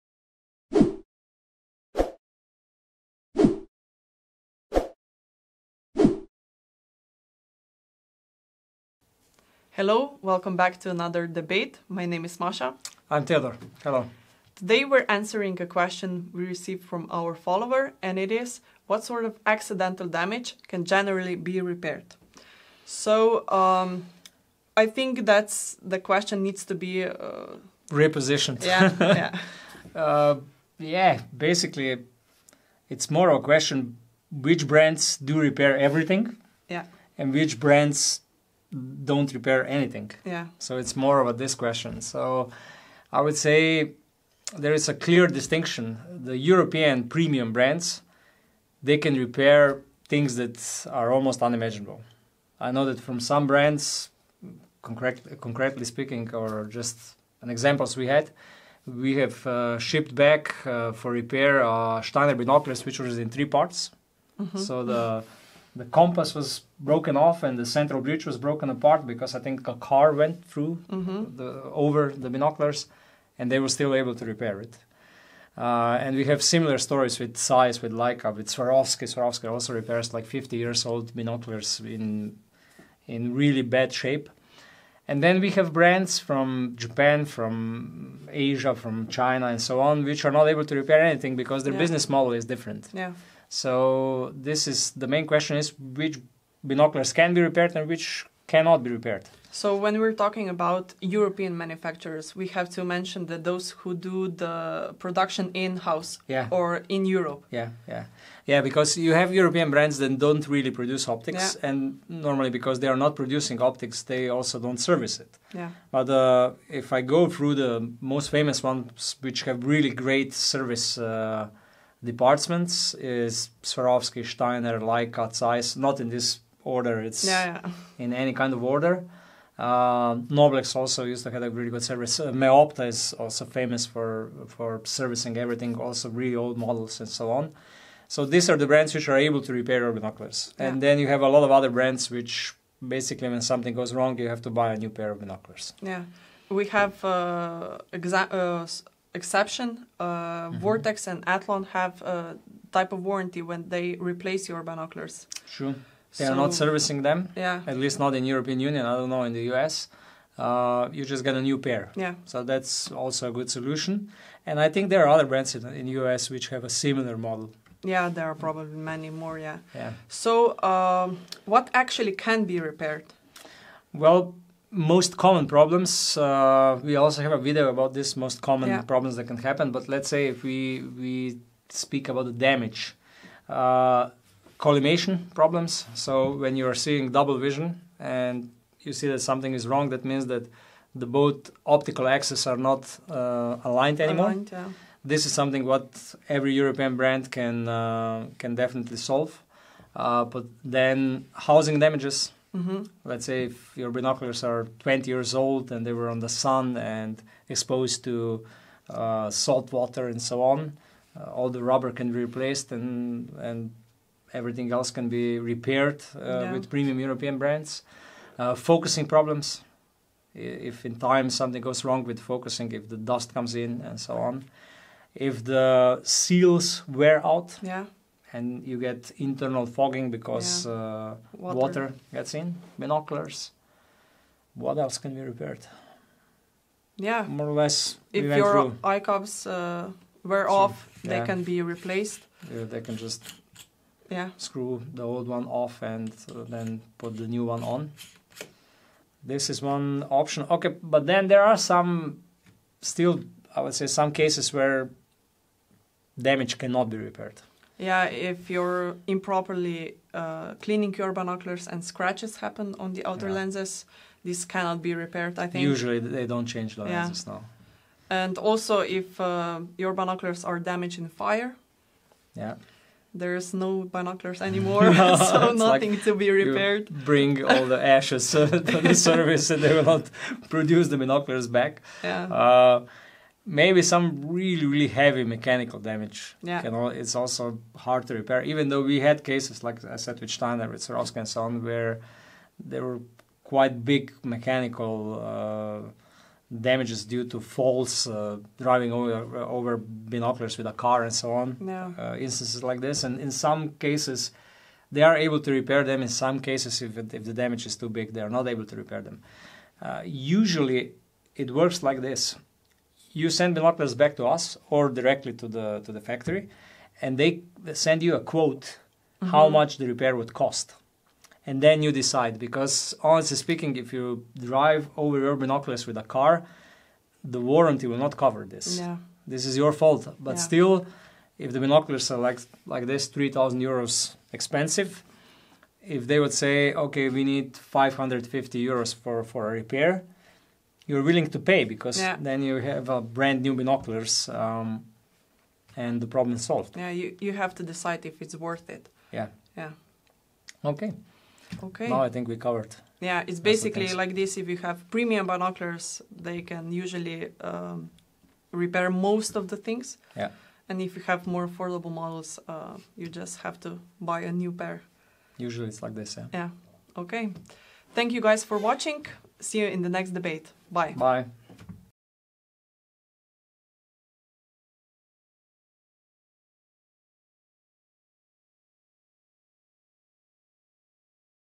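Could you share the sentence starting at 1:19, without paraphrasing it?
Swarovski also repairs like 50 years old binoculars in in really bad shape.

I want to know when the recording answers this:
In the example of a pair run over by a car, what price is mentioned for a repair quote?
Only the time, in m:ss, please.
5:37.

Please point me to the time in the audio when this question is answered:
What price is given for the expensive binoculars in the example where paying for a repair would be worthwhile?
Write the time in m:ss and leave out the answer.
5:33.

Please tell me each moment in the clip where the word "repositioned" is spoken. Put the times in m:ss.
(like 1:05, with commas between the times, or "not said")
0:27.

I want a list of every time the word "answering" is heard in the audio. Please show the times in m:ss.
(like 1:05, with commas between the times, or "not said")
0:15.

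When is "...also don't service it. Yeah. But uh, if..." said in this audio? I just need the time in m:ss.
1:54.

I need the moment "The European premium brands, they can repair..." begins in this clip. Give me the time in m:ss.
0:46.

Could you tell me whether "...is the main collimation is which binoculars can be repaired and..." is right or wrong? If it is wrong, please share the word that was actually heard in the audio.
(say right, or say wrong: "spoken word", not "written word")
wrong: "question", not "collimation".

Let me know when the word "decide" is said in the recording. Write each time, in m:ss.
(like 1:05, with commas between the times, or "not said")
5:21, 5:47.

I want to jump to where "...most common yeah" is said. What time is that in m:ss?
2:58.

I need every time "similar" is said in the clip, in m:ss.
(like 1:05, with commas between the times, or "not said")
1:16, 2:46.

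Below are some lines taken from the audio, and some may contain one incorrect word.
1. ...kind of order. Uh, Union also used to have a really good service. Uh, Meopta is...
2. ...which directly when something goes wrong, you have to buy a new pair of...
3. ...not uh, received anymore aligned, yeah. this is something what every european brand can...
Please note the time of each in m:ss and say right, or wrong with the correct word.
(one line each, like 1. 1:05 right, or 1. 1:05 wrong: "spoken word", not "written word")
1. 2:08 wrong: "Noblex", not "Union"
2. 2:22 wrong: "basically", not "directly"
3. 3:12 wrong: "aligned", not "received".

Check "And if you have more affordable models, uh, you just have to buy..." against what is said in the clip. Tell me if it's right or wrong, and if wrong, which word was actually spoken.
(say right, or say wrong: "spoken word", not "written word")
right.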